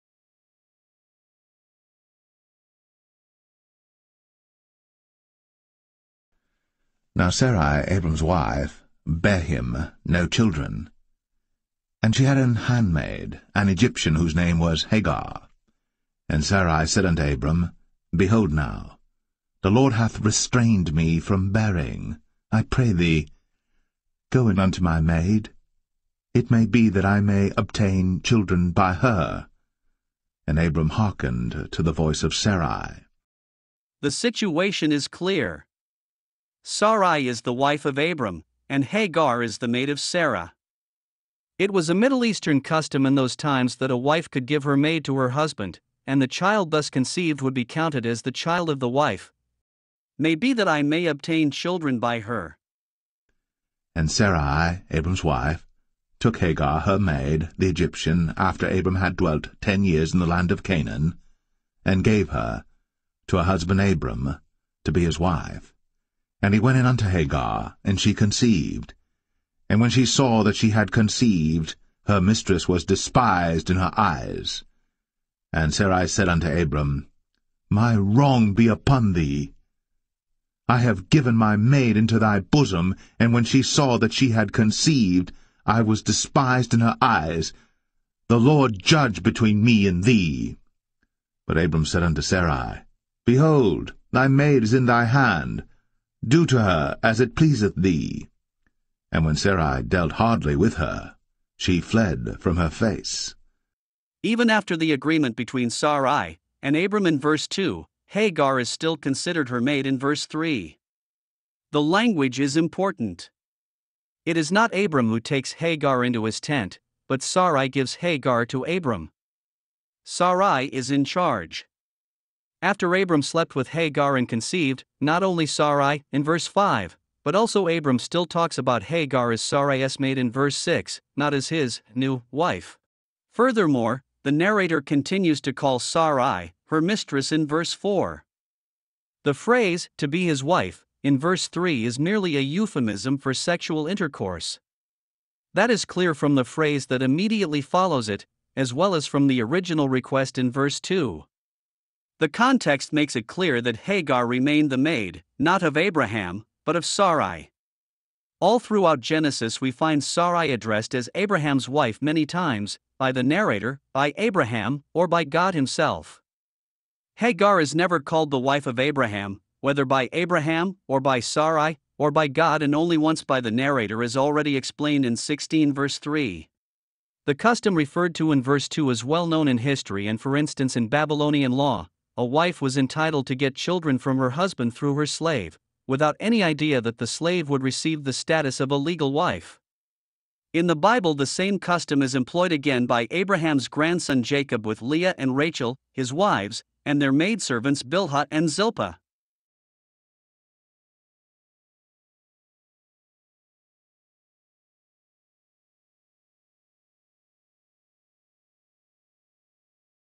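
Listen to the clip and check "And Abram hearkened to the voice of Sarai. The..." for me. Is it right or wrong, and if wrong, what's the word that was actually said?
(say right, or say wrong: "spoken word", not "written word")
right.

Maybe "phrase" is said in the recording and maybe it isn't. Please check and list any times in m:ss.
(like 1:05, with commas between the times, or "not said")
2:19, 2:26.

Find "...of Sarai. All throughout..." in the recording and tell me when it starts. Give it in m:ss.
2:36.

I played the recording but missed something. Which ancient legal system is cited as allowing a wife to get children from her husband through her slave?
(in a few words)
Babylonian law.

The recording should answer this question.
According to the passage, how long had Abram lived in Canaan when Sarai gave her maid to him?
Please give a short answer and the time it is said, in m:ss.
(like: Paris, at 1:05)
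10 years, at 0:59.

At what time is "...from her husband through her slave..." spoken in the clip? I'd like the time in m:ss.
3:03.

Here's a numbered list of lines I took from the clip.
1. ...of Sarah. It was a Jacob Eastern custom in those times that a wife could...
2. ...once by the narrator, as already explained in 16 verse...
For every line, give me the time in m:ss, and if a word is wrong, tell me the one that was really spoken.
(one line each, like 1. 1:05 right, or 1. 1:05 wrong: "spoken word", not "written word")
1. 0:39 wrong: "Middle", not "Jacob"
2. 2:52 right.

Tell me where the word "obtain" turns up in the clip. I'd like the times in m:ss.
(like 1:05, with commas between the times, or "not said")
0:27, 0:51.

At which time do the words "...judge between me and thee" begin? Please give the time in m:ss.
1:28.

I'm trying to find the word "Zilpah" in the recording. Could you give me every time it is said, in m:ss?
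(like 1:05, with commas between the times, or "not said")
3:18.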